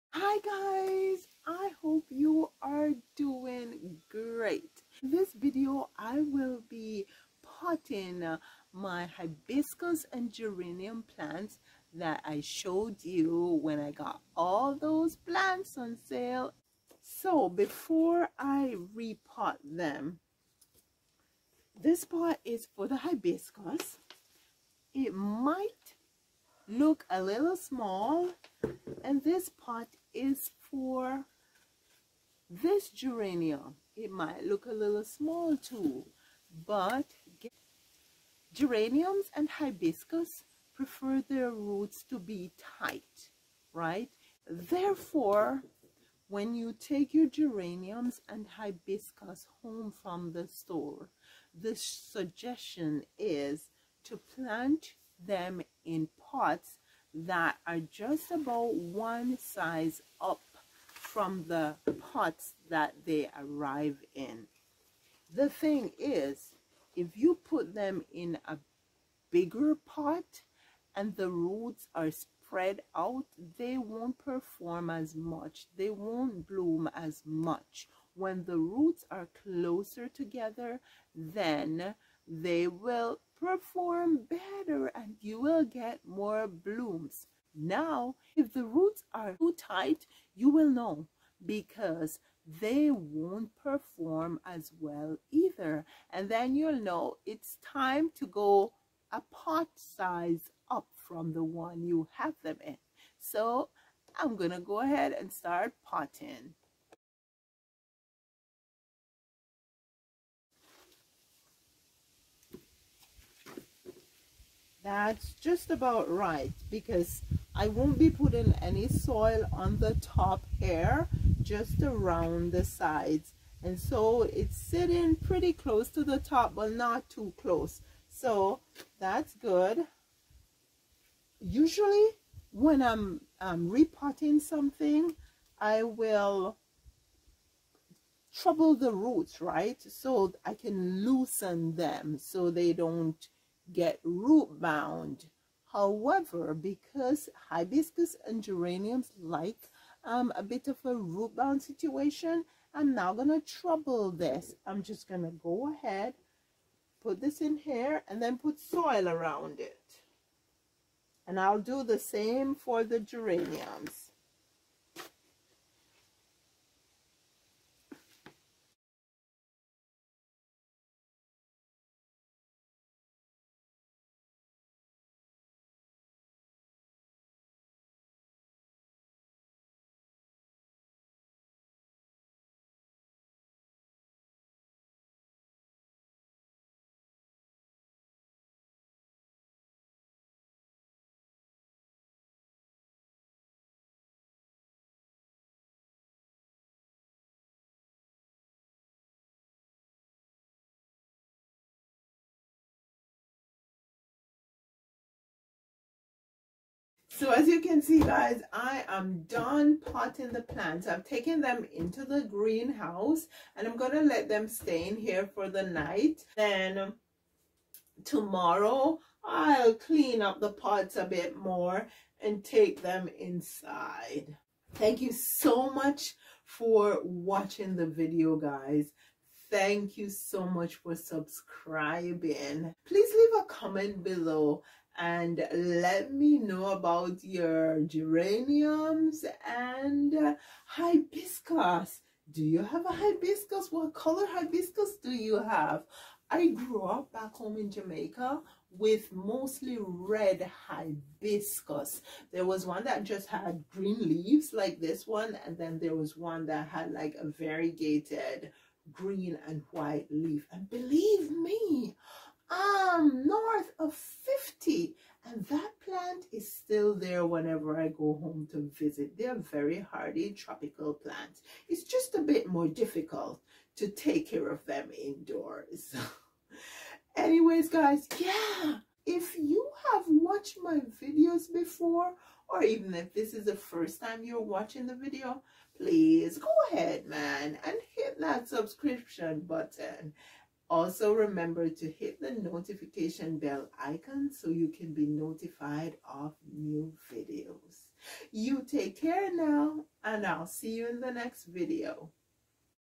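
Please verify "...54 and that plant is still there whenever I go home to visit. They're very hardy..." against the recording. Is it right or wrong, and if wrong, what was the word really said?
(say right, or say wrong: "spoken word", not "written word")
wrong: "50", not "54".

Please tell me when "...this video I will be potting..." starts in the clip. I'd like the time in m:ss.
0:05.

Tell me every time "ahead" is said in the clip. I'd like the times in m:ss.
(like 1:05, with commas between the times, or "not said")
1:44, 2:35, 4:46.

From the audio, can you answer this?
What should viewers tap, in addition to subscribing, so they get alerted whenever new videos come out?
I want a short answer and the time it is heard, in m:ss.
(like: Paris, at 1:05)
notification bell icon, at 4:52.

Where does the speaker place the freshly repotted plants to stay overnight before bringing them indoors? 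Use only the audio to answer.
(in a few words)
greenhouse.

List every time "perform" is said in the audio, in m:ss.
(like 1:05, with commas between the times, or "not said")
1:14, 1:23, 1:33.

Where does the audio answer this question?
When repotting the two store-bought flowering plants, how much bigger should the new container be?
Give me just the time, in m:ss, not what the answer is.
0:58.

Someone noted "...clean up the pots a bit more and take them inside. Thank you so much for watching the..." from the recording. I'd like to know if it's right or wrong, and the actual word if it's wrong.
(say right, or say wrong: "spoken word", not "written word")
right.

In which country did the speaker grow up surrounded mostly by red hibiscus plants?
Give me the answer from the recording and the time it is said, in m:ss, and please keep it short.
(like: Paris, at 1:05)
Jamaica, at 4:07.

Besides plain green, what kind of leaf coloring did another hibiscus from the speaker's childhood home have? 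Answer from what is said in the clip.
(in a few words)
variegated green and white.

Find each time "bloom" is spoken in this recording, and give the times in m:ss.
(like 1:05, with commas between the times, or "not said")
1:16, 1:26.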